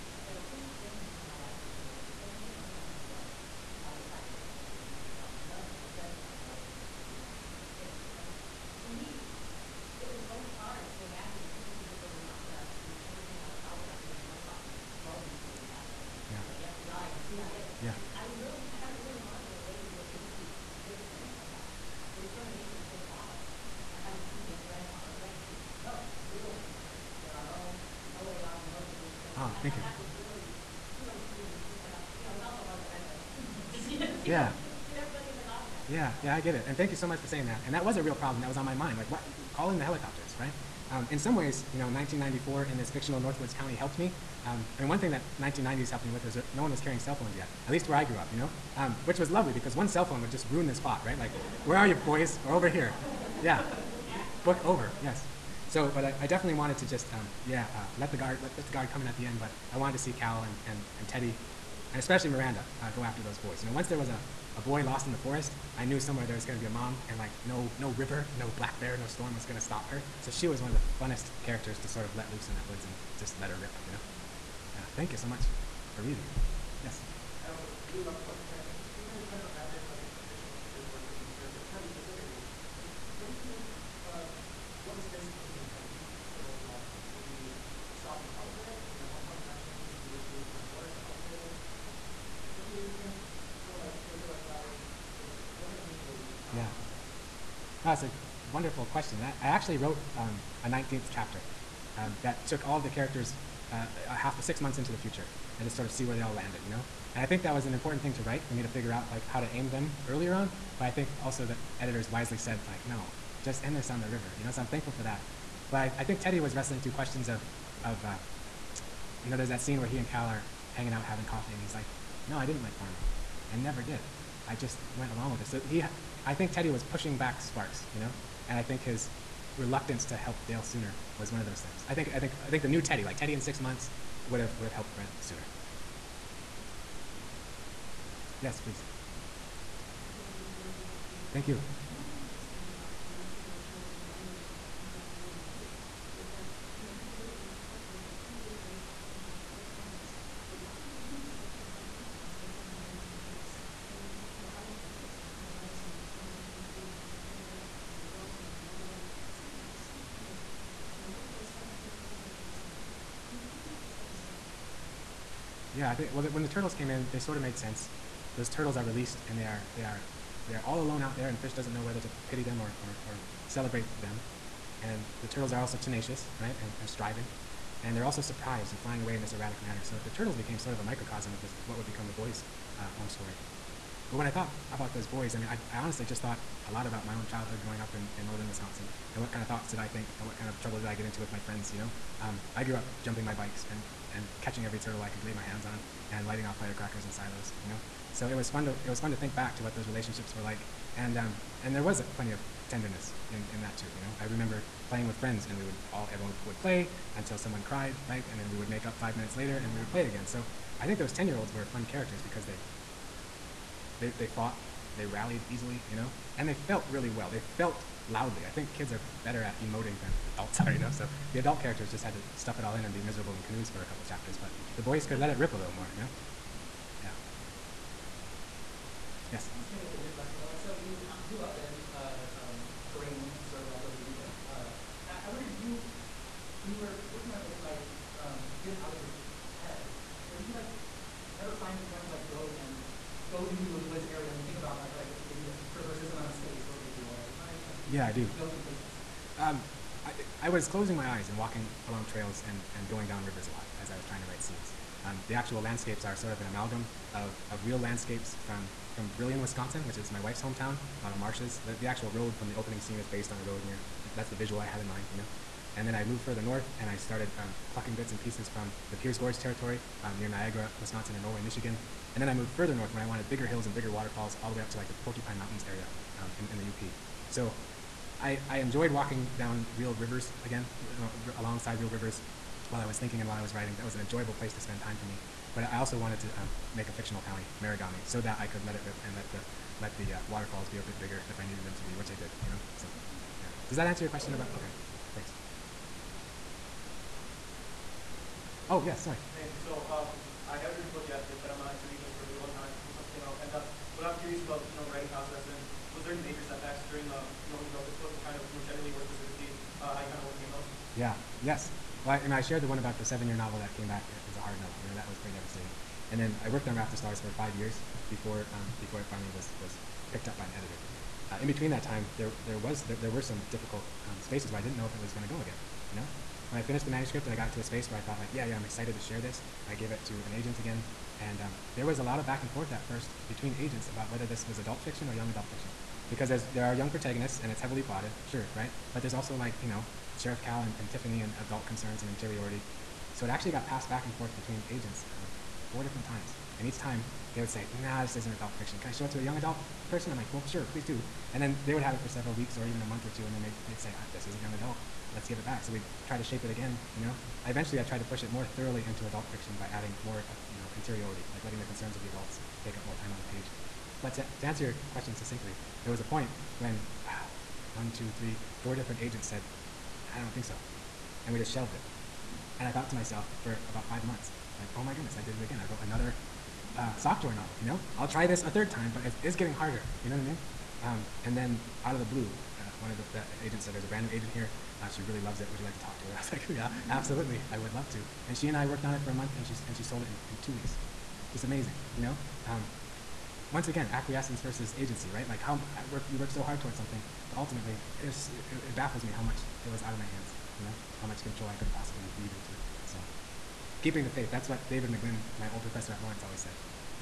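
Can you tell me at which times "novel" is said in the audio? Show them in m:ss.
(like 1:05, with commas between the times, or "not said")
5:13, 6:17.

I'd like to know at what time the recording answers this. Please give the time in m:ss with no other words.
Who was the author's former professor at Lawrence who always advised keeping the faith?
6:44.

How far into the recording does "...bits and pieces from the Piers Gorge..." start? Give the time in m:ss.
4:27.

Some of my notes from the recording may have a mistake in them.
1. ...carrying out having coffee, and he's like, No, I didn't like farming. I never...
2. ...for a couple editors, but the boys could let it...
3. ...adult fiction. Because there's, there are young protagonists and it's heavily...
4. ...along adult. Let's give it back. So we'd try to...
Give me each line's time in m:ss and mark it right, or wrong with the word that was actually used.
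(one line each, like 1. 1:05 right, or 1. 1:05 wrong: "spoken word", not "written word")
1. 2:00 wrong: "hanging", not "carrying"
2. 3:43 wrong: "chapters", not "editors"
3. 5:35 right
4. 5:54 wrong: "young", not "along".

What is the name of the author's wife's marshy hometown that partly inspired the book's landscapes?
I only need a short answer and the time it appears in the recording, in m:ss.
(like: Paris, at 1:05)
Brillion, Wisconsin, at 4:19.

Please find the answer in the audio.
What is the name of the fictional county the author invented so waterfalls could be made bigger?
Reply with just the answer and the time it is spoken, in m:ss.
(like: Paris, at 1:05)
Marigami, at 4:47.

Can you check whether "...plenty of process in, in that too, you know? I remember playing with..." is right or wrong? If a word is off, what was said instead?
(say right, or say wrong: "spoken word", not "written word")
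wrong: "tenderness", not "process".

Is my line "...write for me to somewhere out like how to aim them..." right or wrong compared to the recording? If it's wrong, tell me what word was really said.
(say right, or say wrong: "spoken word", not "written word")
wrong: "figure", not "somewhere".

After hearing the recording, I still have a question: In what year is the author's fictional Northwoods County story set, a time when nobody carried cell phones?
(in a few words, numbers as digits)
1994.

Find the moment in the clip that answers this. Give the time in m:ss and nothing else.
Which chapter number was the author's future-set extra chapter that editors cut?
1:40.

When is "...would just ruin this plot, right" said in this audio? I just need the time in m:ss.
0:50.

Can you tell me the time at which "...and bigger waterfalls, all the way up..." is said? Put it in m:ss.
4:33.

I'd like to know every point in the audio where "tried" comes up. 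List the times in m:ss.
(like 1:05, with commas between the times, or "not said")
5:57.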